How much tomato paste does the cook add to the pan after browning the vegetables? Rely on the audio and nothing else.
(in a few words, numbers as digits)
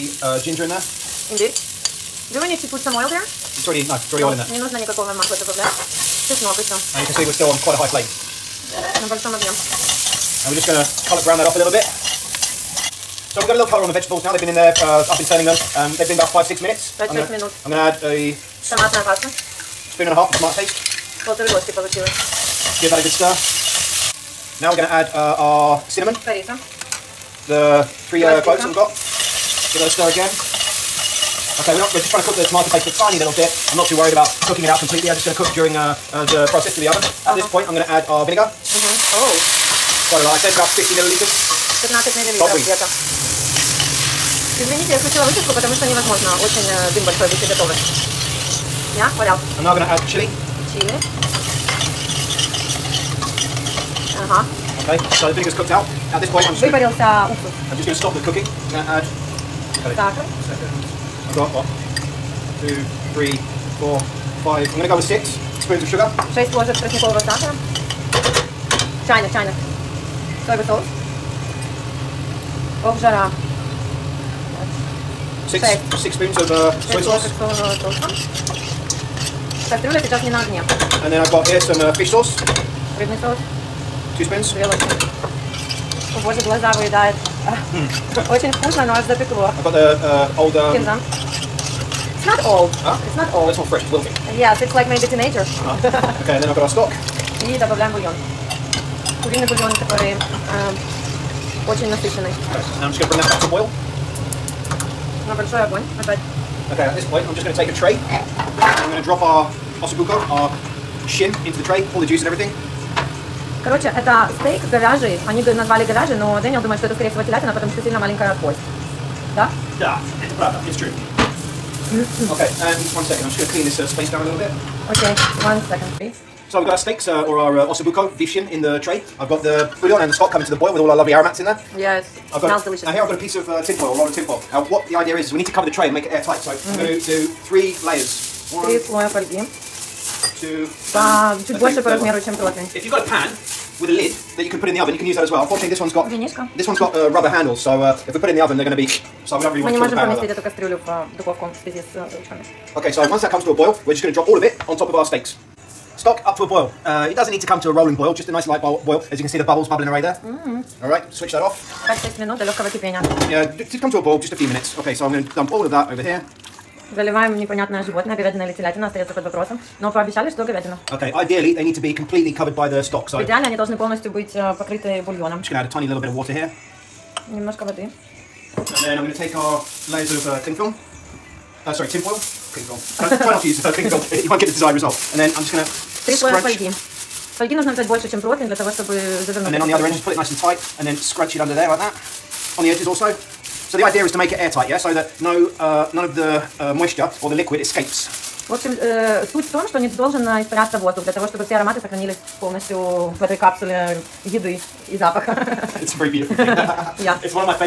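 Spoon and a half.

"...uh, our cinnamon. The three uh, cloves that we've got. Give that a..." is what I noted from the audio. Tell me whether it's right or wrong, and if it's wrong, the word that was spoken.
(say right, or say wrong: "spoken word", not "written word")
right.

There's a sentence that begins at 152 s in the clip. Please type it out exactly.
Okay, so once that comes to a boil, we're just going to drop all of it on top of our steaks.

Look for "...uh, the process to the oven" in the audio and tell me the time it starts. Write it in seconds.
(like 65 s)
36 s.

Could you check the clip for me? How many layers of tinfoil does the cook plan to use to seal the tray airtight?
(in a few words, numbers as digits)
3.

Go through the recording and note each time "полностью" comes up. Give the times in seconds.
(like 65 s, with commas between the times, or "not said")
173 s, 202 s.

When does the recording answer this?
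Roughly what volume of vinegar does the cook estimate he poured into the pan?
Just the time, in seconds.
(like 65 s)
40 s.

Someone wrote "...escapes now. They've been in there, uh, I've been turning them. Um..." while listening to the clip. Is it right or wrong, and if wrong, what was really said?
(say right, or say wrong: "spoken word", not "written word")
wrong: "vegetables", not "escapes".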